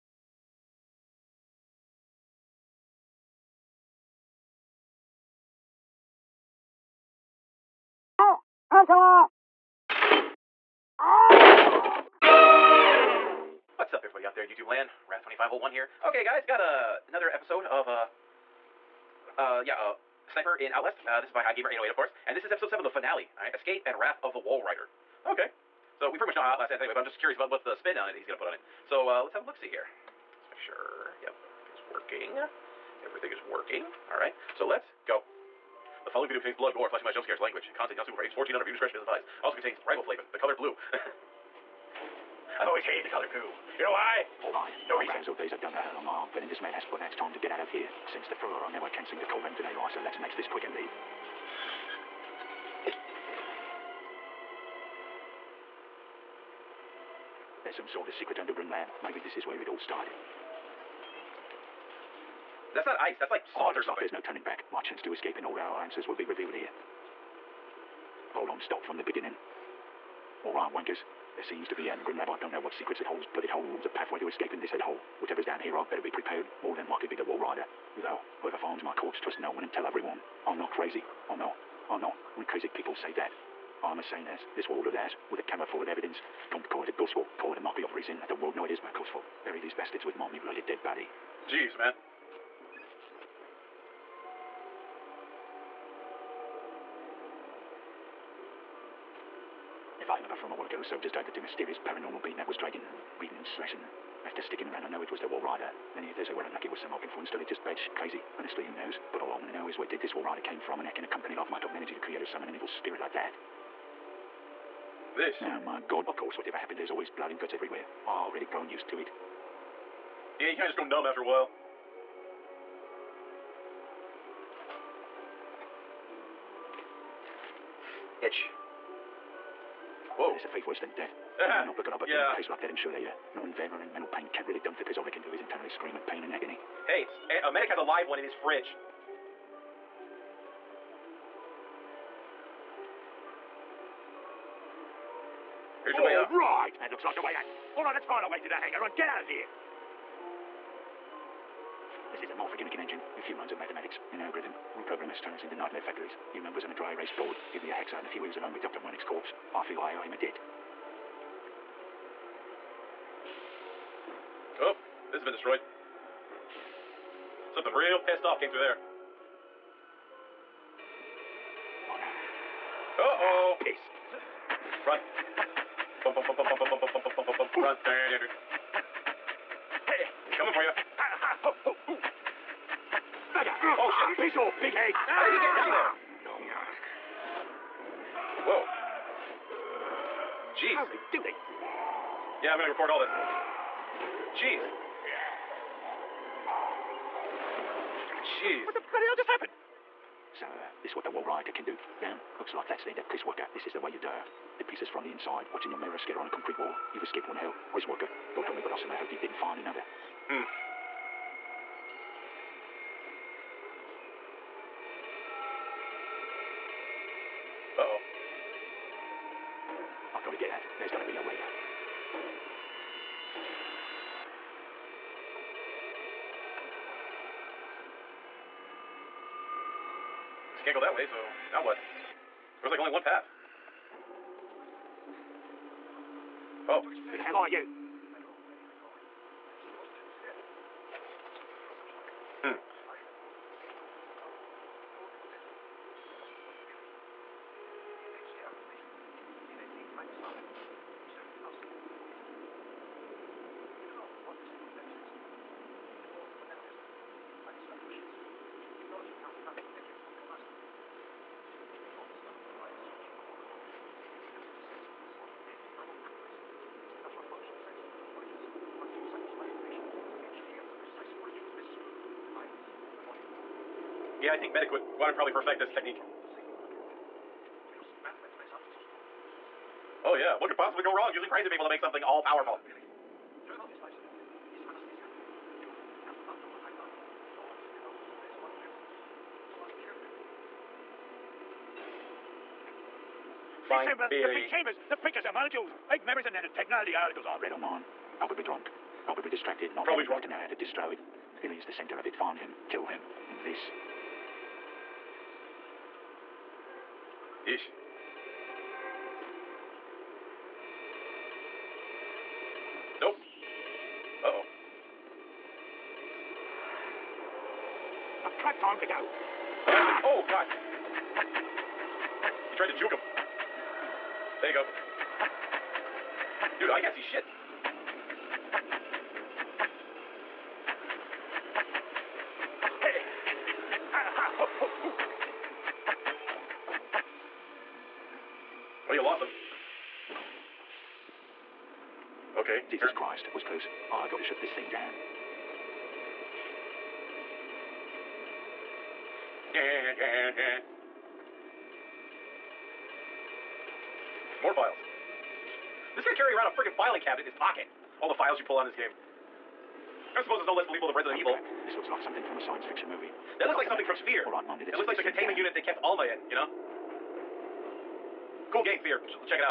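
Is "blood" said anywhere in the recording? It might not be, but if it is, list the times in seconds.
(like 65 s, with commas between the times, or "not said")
36 s, 117 s.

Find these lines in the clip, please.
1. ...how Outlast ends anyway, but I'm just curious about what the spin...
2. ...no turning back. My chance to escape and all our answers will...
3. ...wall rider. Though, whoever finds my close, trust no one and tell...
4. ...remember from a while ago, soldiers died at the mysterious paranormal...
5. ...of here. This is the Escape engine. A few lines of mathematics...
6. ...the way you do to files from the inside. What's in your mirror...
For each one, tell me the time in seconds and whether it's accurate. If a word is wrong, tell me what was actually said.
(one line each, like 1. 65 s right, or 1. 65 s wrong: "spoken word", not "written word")
1. 26 s right
2. 64 s right
3. 77 s wrong: "corpse", not "close"
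4. 100 s right
5. 149 s wrong: "Morphogenic", not "Escape"
6. 203 s wrong: "pieces", not "files".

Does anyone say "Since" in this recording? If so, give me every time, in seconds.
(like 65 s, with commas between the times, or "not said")
48 s.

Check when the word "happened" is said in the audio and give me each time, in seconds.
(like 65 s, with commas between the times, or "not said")
116 s, 199 s.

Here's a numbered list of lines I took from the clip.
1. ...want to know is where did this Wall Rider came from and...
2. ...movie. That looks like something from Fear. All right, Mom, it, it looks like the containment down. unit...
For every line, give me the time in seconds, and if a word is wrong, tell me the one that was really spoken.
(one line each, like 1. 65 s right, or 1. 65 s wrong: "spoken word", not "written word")
1. 109 s right
2. 362 s right.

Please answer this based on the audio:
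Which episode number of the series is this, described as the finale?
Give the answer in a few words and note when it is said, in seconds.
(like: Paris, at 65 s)
7, at 22 s.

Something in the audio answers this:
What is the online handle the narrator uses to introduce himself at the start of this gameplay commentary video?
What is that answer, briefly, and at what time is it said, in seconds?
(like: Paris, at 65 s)
Wrath2501, at 15 s.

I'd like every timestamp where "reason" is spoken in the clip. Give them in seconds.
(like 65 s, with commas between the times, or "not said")
45 s, 87 s.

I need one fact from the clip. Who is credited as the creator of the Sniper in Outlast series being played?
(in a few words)
High Gamer 808.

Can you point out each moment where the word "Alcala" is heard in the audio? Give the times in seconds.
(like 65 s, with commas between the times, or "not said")
8 s.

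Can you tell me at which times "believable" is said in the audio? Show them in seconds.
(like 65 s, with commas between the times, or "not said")
360 s.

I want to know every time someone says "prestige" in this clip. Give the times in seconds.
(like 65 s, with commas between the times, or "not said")
not said.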